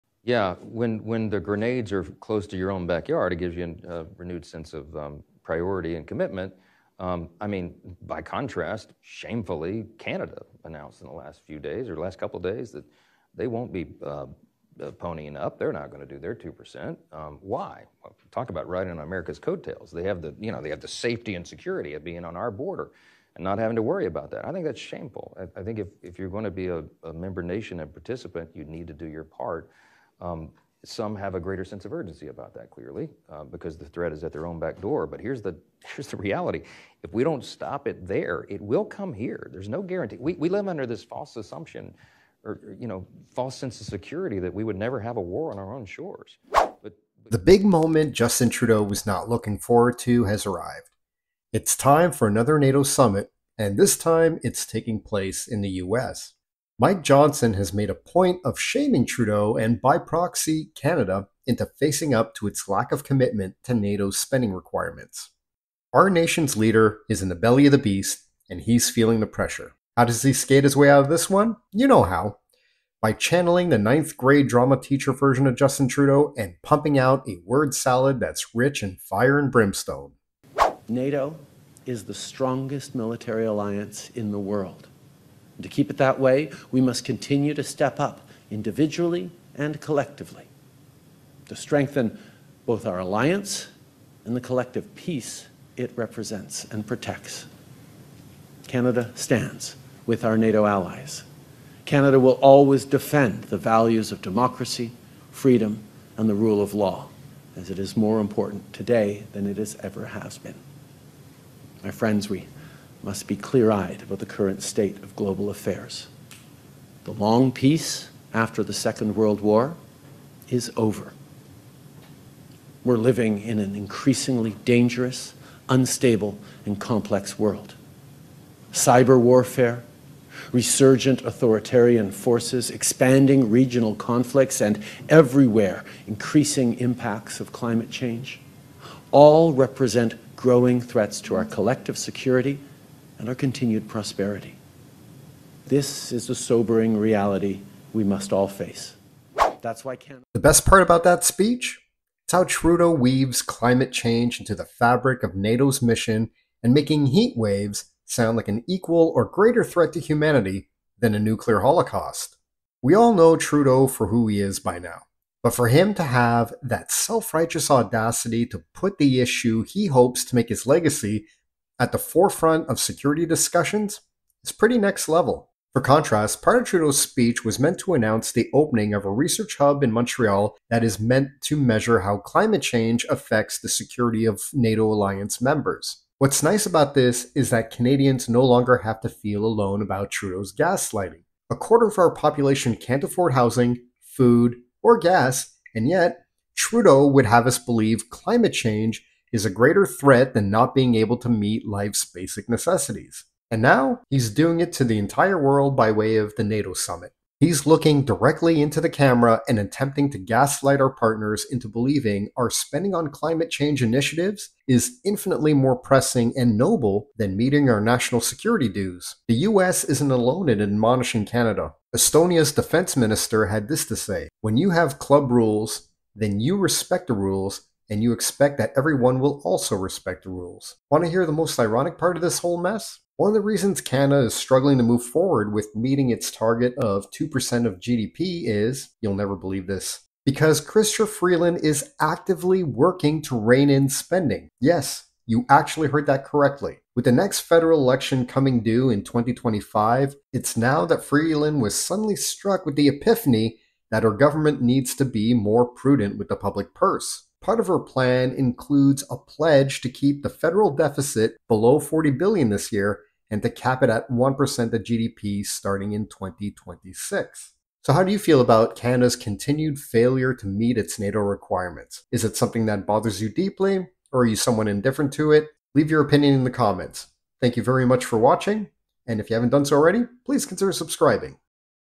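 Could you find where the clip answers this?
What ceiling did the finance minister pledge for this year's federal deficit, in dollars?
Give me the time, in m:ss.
4:21.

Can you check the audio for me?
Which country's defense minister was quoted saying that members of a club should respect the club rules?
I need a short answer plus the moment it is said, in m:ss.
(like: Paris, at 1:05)
Estonia, at 3:41.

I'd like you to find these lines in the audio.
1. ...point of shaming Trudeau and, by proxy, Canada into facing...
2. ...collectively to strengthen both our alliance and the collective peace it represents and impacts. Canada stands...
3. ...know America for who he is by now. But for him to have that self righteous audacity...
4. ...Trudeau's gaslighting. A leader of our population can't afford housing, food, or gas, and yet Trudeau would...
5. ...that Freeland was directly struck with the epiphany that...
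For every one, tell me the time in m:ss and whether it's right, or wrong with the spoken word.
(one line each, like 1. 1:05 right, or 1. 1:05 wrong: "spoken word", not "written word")
1. 0:57 right
2. 1:29 wrong: "protects", not "impacts"
3. 2:43 wrong: "Trudeau", not "America"
4. 3:10 wrong: "quarter", not "leader"
5. 4:10 wrong: "suddenly", not "directly".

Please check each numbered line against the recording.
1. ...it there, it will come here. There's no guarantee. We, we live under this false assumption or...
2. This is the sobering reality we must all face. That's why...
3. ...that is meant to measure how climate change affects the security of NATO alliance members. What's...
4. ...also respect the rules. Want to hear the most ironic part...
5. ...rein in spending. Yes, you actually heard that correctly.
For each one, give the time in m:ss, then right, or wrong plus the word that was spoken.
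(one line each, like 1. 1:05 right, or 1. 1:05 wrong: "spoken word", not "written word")
1. 0:37 right
2. 2:25 right
3. 3:00 right
4. 3:49 right
5. 4:03 right.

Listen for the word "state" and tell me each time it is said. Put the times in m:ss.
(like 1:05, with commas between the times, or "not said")
1:54.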